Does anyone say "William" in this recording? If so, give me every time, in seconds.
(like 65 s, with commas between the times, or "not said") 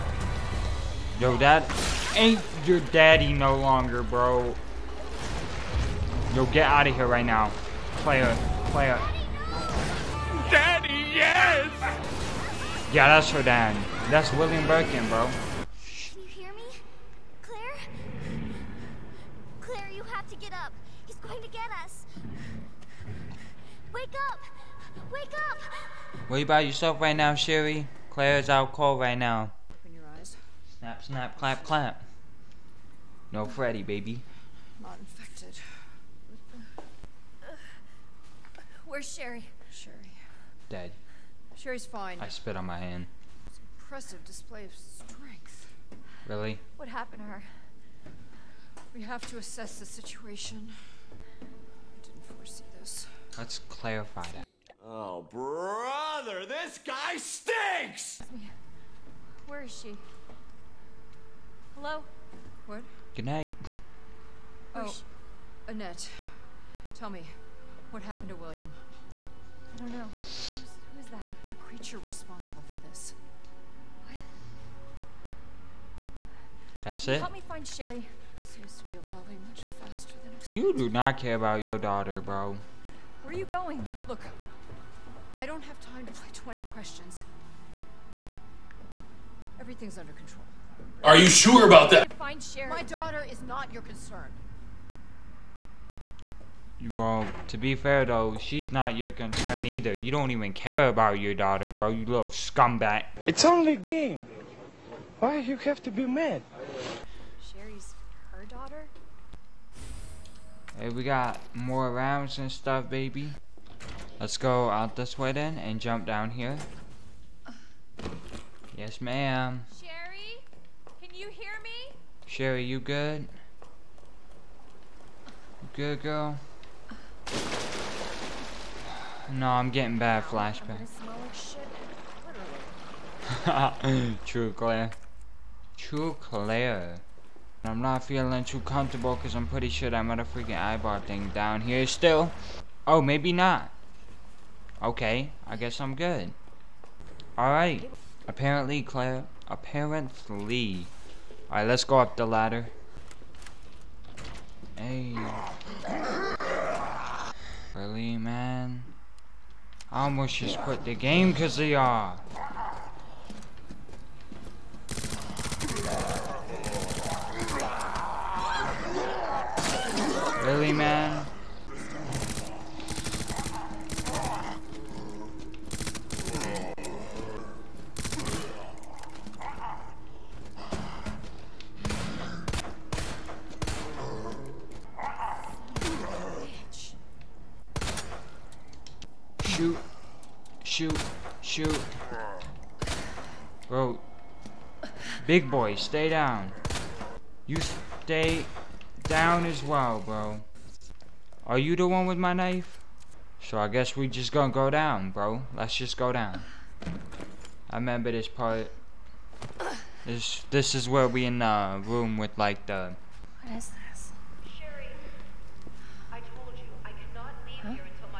14 s, 68 s.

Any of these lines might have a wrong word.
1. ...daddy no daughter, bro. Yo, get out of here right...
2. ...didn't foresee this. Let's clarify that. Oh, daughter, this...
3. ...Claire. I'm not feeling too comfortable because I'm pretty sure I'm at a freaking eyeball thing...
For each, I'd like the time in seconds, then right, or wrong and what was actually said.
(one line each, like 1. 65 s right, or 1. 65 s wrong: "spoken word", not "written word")
1. 2 s wrong: "longer", not "daughter"
2. 52 s wrong: "brother", not "daughter"
3. 136 s right.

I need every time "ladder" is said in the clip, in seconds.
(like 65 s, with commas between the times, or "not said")
152 s.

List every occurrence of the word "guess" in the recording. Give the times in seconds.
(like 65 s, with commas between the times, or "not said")
145 s, 203 s.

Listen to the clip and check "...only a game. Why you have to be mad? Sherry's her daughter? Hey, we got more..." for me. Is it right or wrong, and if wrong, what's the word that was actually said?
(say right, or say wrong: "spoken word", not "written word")
right.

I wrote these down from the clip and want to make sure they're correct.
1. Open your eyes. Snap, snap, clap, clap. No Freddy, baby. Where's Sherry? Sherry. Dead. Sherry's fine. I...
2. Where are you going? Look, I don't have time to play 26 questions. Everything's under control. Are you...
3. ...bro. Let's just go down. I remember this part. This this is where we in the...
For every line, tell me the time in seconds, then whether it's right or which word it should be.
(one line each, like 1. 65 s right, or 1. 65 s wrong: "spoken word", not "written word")
1. 29 s right
2. 83 s wrong: "20", not "26"
3. 205 s right.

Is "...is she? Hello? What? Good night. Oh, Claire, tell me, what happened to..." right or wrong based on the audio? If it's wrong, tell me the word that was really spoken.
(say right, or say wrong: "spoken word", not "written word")
wrong: "Annette", not "Claire".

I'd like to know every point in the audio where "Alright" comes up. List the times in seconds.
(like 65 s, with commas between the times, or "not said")
147 s, 151 s.